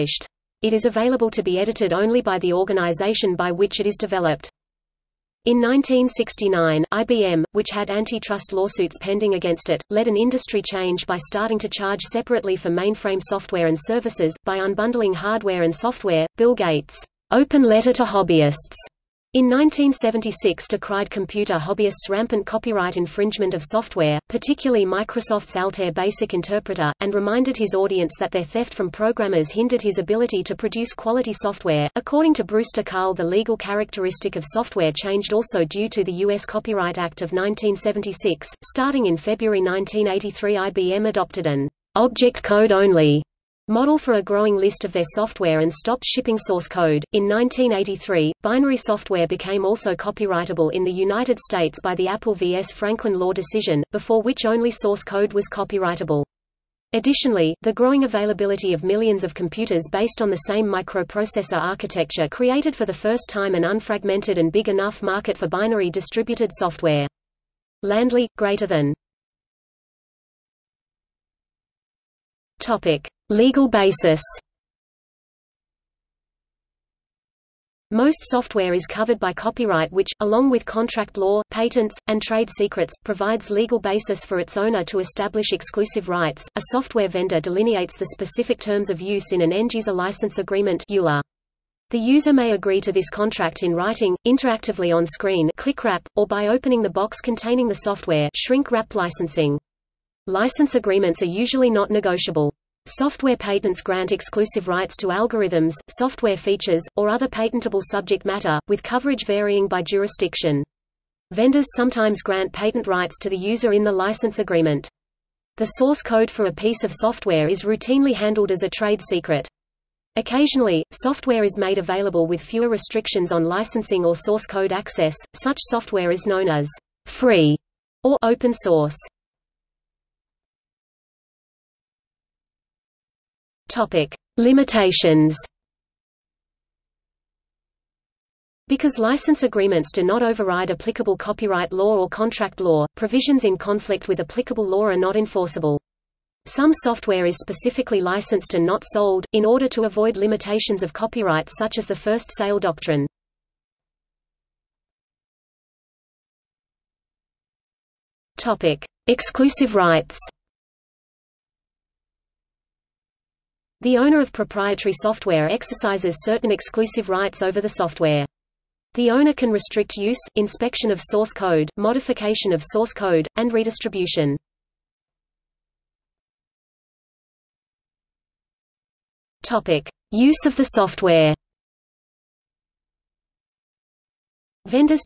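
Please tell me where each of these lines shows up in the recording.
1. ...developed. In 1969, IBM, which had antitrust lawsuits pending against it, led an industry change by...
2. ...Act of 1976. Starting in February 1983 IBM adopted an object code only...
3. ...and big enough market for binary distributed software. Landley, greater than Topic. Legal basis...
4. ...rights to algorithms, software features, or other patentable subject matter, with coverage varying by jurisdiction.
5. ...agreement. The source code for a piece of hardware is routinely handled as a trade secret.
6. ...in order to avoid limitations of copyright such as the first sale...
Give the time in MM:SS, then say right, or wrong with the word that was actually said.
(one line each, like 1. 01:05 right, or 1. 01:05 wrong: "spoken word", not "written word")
1. 00:03 right
2. 00:36 right
3. 01:04 right
4. 01:44 right
5. 01:54 wrong: "software", not "hardware"
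6. 02:29 right.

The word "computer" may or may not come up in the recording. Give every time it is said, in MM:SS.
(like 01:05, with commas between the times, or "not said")
00:21, 00:59.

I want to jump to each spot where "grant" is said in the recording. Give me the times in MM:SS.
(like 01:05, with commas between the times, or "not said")
01:43, 01:52.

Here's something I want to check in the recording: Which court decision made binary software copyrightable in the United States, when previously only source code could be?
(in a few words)
Apple vs. Franklin.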